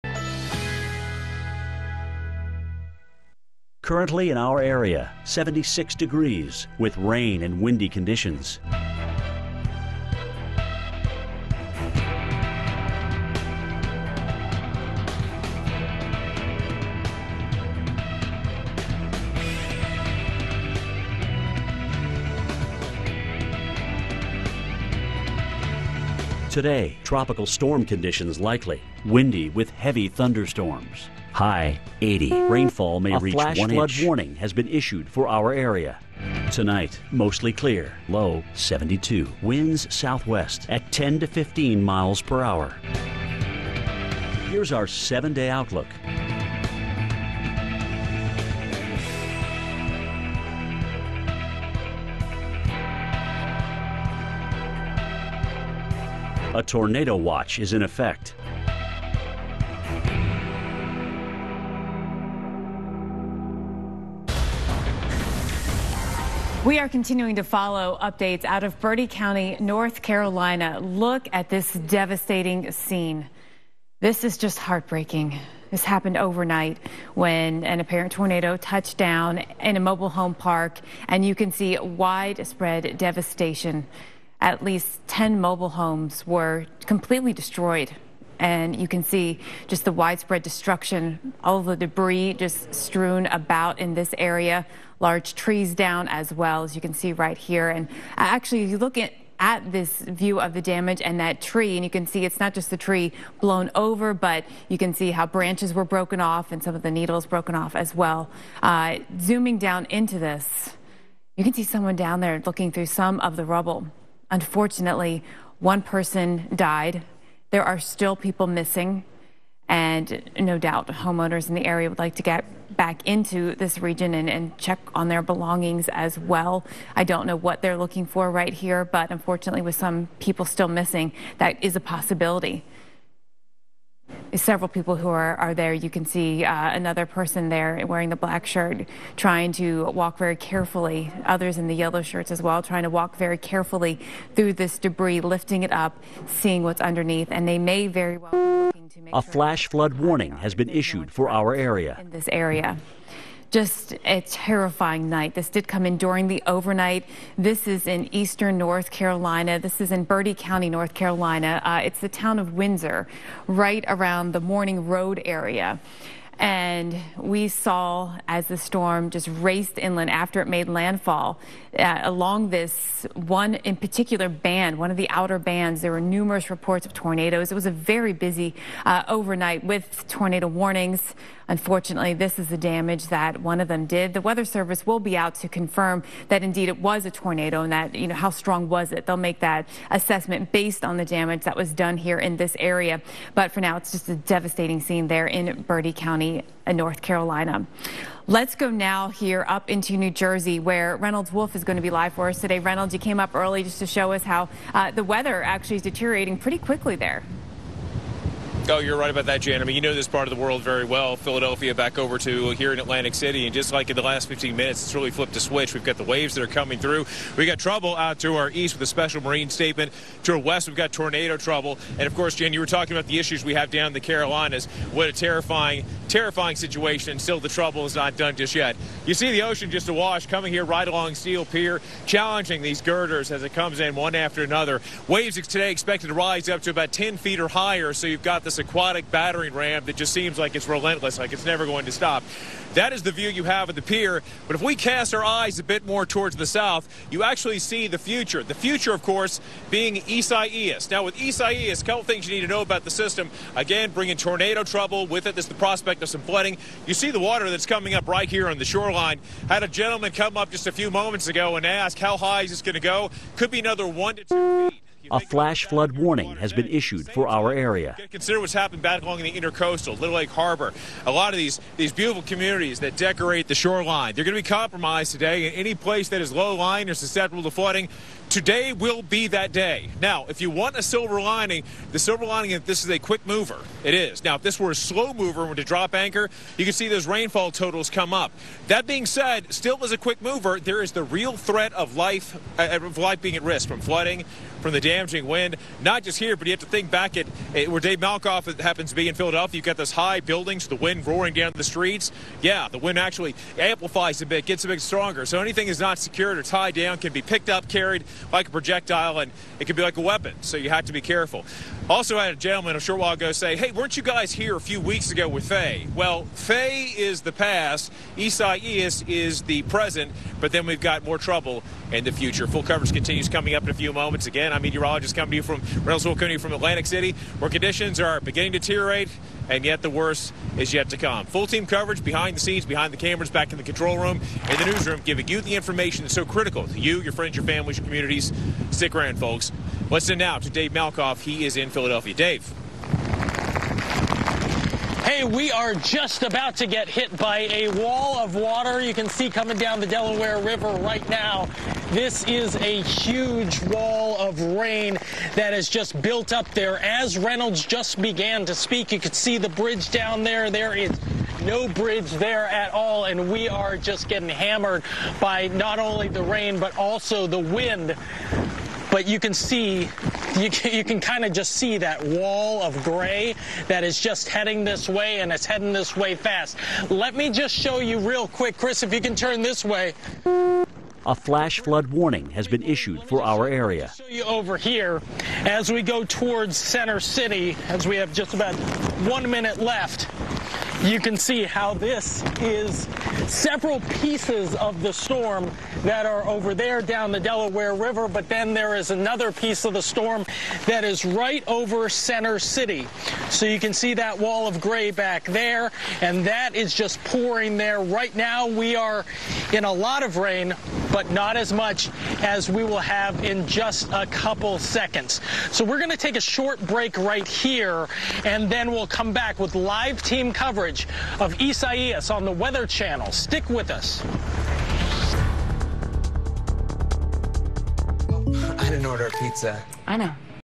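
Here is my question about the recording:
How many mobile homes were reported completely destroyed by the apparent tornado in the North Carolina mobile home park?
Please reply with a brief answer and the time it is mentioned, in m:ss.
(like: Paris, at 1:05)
10, at 1:24.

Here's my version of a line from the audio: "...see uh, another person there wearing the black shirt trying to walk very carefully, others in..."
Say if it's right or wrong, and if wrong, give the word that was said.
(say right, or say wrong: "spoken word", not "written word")
right.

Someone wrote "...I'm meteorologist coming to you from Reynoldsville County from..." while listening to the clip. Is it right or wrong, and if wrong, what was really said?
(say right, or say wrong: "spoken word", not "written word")
right.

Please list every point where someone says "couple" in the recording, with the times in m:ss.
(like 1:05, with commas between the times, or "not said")
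4:11, 6:54.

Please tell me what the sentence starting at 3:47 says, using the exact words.
And still, the trouble is not done just yet.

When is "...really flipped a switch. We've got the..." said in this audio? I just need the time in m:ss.
3:34.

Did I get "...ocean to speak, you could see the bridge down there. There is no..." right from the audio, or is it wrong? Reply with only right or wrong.
wrong.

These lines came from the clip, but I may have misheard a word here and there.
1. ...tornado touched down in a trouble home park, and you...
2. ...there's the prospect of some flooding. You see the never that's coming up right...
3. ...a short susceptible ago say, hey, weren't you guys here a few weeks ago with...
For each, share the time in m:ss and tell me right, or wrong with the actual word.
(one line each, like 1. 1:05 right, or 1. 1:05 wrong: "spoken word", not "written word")
1. 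1:18 wrong: "mobile", not "trouble"
2. 4:15 wrong: "water", not "never"
3. 5:12 wrong: "while", not "susceptible".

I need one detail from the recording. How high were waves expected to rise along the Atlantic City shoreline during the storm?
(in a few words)
10 feet.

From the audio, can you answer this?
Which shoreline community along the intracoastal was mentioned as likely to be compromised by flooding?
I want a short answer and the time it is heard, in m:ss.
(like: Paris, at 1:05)
Little Egg Harbor, at 4:29.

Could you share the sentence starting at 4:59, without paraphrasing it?
You've got those high buildings, the wind roaring down the streets.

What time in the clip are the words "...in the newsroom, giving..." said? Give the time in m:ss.
5:34.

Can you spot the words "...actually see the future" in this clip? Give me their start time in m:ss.
4:07.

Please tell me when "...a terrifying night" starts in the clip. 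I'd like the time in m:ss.
2:34.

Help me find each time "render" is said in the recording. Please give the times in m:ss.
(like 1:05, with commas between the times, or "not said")
not said.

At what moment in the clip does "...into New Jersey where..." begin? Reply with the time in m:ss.
3:19.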